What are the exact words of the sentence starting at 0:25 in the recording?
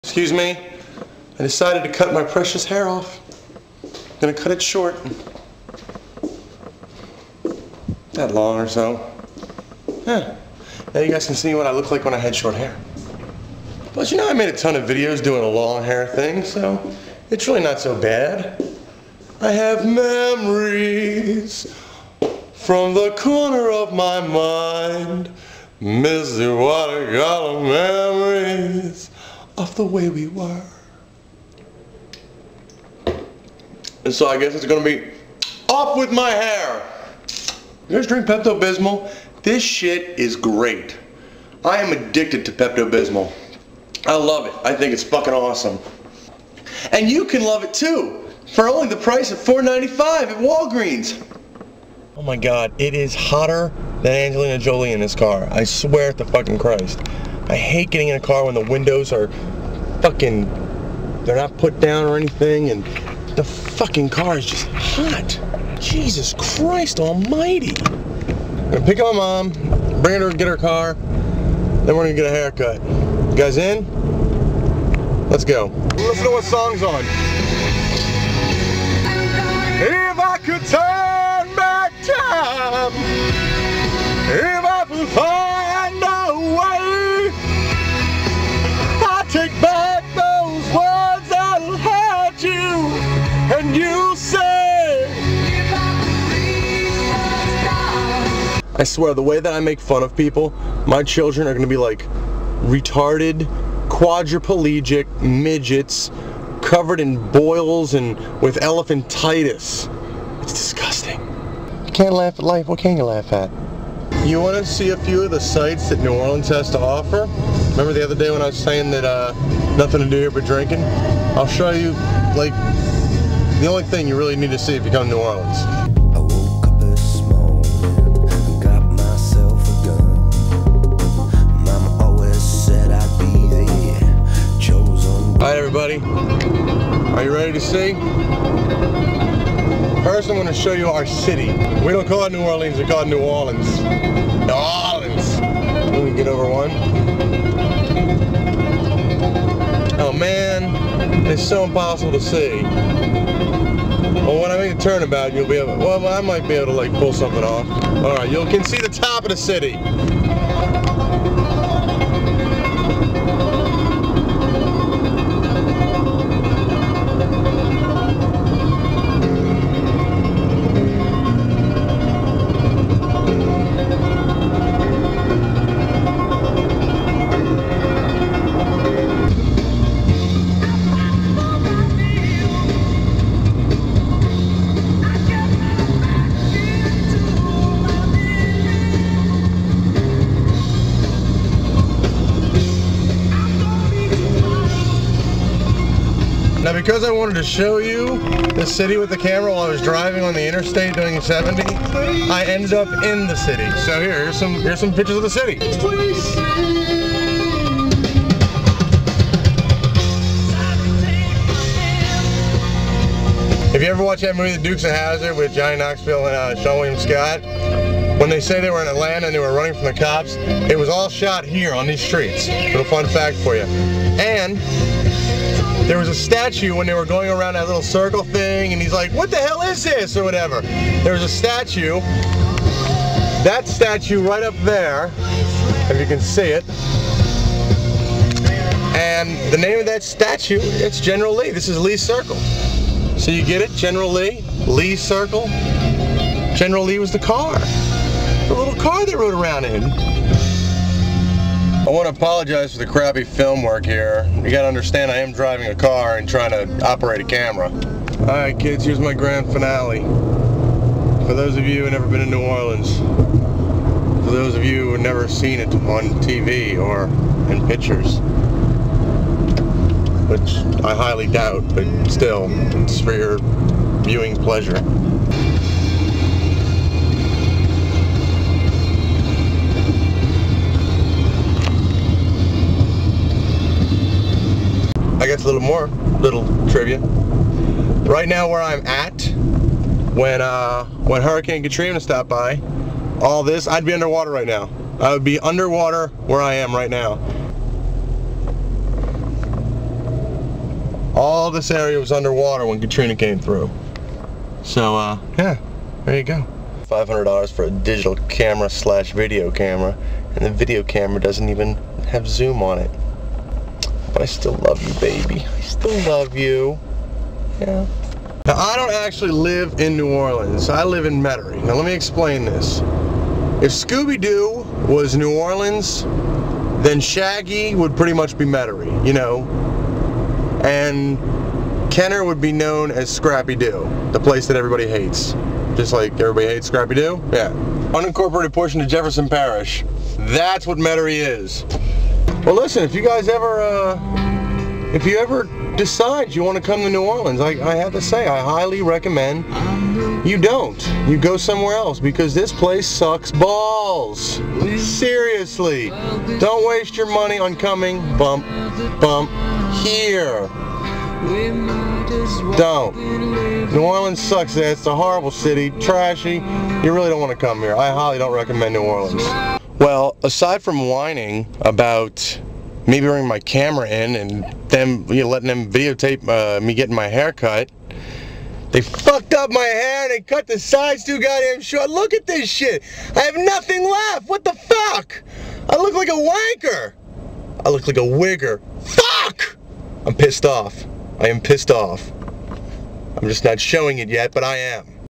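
Missy, what got of memories of the way we were.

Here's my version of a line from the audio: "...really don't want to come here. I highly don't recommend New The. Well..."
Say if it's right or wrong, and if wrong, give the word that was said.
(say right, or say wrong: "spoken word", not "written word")
wrong: "Orleans", not "The".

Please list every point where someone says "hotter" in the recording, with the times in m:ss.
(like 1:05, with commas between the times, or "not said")
0:53.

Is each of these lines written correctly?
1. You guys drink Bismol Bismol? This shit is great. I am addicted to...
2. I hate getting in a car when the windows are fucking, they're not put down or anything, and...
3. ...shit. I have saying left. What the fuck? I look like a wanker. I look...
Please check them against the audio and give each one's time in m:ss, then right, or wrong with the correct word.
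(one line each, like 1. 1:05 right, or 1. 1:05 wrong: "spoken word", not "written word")
1. 0:37 wrong: "Pepto", not "Bismol"
2. 0:57 right
3. 6:22 wrong: "nothing", not "saying".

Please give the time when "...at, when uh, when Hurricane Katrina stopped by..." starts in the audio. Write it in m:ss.
4:48.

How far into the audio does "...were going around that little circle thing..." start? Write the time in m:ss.
3:46.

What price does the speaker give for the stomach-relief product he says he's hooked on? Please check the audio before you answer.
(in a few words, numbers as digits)
$4.95.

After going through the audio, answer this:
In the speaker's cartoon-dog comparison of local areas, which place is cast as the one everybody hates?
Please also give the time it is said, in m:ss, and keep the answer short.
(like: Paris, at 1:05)
Kenner, at 5:31.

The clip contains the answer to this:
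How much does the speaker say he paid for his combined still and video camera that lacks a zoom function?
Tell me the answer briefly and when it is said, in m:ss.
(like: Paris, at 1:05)
$500, at 5:06.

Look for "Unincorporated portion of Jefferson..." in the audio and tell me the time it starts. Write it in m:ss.
5:37.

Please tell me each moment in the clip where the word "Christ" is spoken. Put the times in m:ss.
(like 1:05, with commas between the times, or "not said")
0:56, 1:06.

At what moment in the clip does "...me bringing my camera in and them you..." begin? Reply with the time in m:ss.
6:12.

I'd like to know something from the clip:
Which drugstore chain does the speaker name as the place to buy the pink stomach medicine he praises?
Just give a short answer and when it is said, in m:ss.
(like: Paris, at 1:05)
Walgreens, at 0:50.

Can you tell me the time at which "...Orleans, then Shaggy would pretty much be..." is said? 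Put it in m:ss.
5:25.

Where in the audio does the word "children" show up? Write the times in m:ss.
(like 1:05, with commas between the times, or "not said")
1:41.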